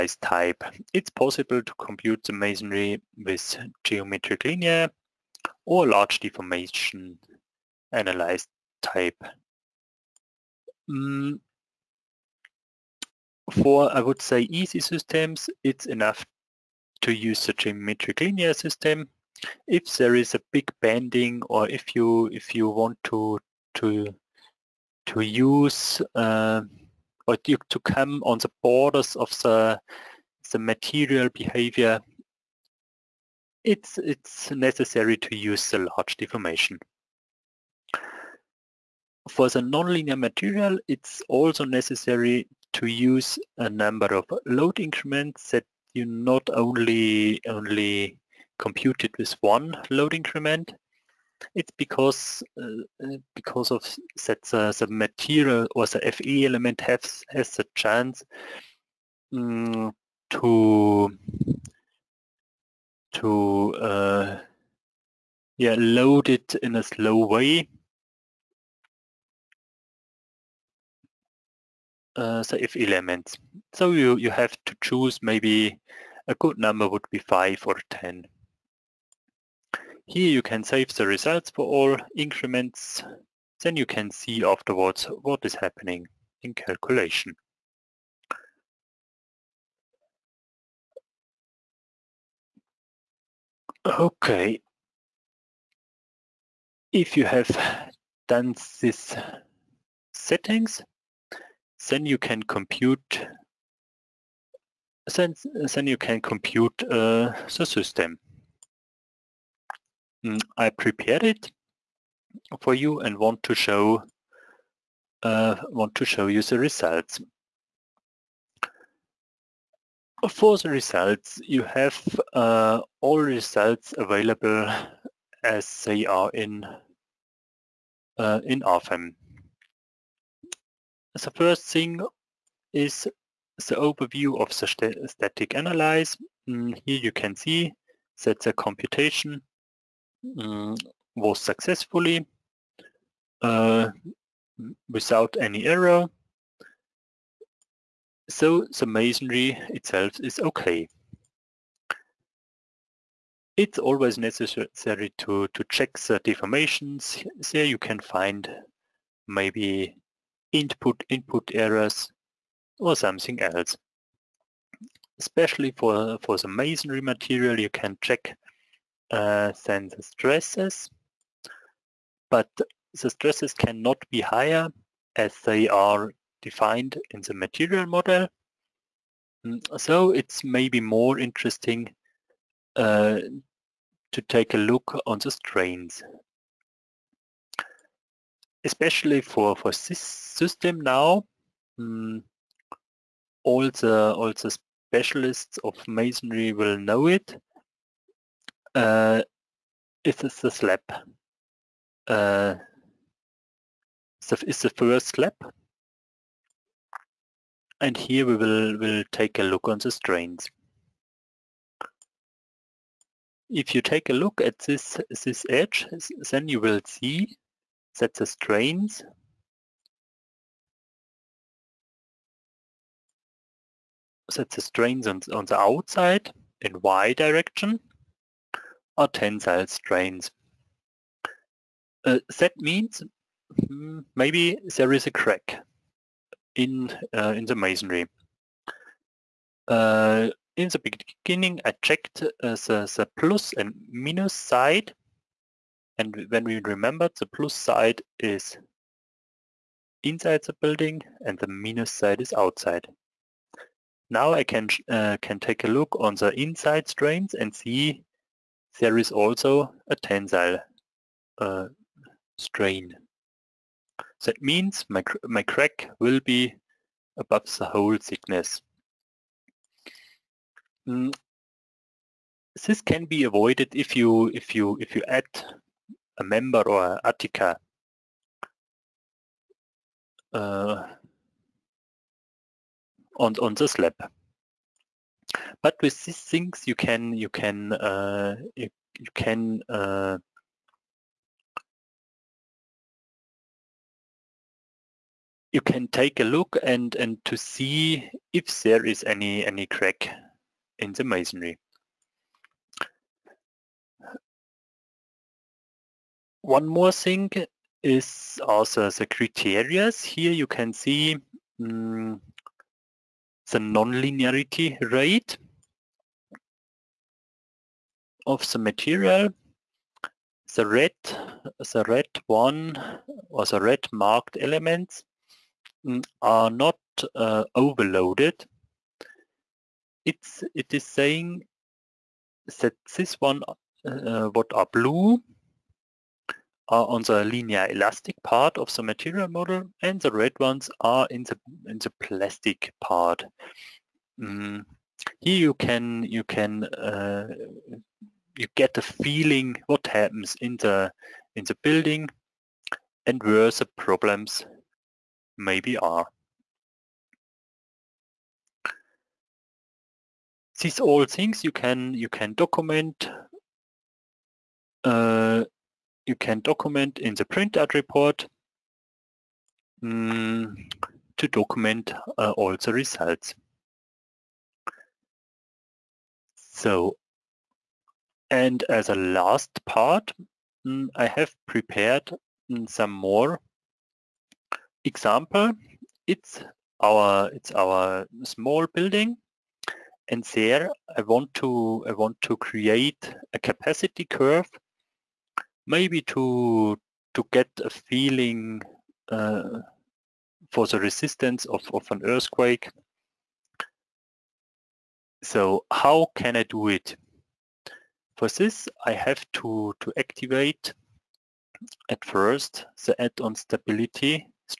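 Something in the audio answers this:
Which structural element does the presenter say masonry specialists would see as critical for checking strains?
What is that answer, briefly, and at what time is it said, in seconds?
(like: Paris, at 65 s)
the first slab, at 204 s.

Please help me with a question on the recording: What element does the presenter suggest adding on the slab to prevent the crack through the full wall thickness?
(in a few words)
an attica.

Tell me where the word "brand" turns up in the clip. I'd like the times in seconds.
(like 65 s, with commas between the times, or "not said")
not said.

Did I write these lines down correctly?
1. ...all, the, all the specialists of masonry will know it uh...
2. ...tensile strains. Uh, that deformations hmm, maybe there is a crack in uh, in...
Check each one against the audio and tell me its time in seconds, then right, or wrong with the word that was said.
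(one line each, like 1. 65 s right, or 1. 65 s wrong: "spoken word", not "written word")
1. 193 s right
2. 229 s wrong: "means", not "deformations".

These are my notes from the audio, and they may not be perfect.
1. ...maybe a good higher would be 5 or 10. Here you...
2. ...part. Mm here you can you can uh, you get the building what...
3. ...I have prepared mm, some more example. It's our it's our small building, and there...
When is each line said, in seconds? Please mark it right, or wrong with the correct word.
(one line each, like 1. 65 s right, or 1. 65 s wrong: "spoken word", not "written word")
1. 75 s wrong: "number", not "higher"
2. 342 s wrong: "feeling", not "building"
3. 380 s right.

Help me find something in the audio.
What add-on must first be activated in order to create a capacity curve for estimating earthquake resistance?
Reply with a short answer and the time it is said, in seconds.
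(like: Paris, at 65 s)
stability, at 413 s.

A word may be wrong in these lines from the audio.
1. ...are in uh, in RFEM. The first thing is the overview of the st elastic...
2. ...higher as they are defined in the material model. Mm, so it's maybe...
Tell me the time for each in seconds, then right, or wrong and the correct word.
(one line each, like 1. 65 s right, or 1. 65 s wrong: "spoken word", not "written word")
1. 126 s wrong: "static", not "elastic"
2. 174 s right.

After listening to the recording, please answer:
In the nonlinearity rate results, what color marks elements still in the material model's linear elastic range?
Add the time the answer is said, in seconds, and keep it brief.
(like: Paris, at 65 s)
blue, at 334 s.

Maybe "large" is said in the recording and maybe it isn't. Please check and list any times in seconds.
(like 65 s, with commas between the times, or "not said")
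5 s, 35 s.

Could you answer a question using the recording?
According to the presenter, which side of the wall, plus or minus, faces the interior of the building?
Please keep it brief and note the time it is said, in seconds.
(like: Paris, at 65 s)
plus side, at 247 s.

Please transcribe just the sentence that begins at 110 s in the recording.
Mm, I prepared it for you and want to show uh, want to show you the results.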